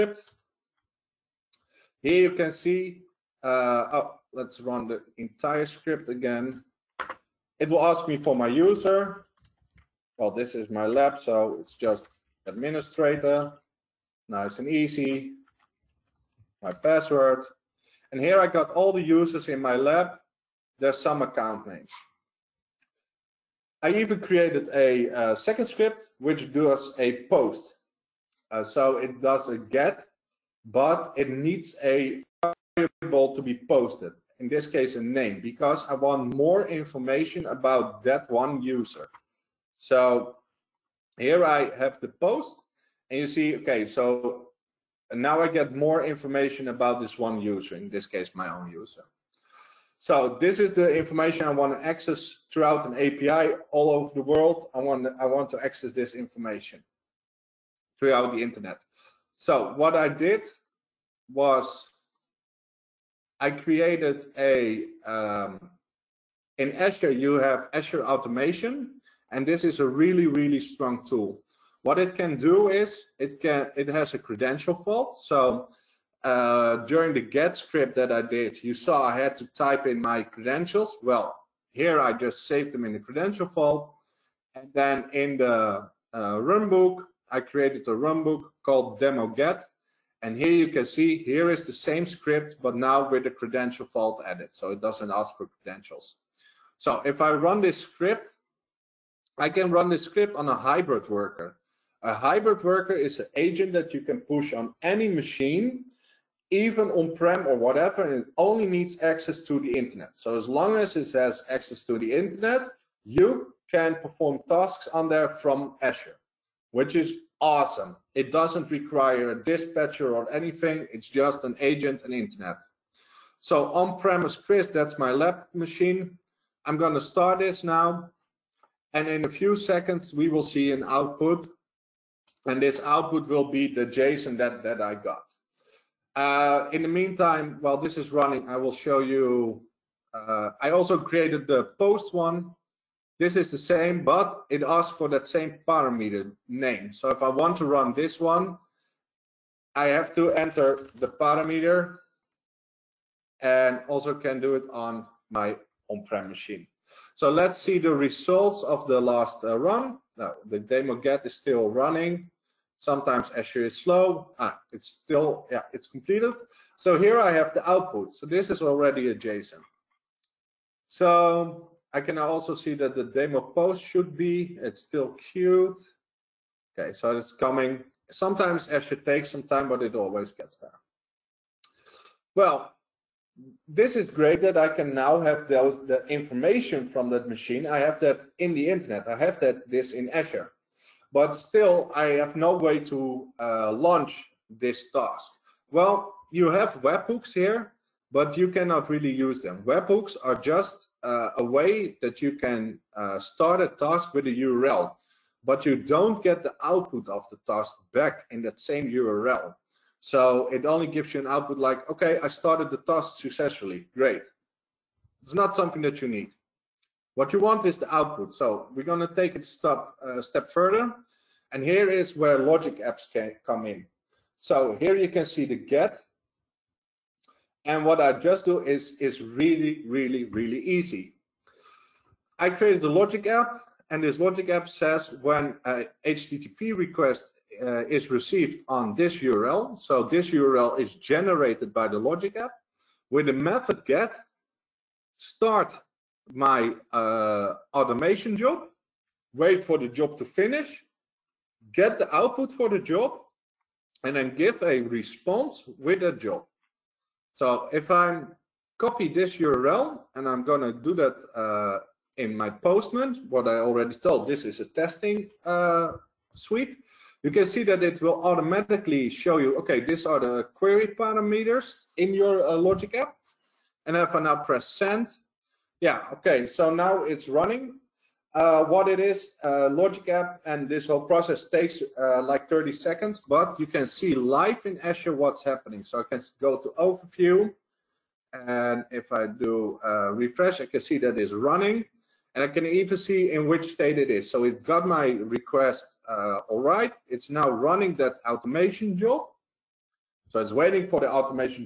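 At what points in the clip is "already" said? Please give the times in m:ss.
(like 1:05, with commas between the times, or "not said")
2:48, 4:23.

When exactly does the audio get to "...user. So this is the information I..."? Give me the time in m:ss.
0:48.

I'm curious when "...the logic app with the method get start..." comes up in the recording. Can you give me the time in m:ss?
4:01.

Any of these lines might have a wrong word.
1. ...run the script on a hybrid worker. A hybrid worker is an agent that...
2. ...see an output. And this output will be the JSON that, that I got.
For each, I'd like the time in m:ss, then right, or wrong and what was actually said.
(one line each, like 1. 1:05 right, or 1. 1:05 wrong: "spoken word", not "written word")
1. 1:39 right
2. 2:10 right.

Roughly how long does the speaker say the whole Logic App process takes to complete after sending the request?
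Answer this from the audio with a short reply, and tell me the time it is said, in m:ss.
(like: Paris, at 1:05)
30 seconds, at 4:42.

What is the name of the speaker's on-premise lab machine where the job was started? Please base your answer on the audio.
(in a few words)
Chris.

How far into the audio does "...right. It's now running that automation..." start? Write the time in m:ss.
4:56.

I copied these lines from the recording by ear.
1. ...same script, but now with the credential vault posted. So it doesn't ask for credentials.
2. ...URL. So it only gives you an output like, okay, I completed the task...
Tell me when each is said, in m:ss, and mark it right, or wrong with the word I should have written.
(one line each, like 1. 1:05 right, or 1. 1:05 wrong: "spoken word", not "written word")
1. 1:31 wrong: "added", not "posted"
2. 3:28 wrong: "started", not "completed".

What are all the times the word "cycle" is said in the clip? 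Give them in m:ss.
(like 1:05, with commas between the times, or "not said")
not said.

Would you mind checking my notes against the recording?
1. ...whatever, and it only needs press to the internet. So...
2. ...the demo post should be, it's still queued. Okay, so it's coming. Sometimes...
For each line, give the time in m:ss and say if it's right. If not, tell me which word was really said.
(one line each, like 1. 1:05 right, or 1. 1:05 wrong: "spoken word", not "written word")
1. 1:47 wrong: "access", not "press"
2. 2:52 right.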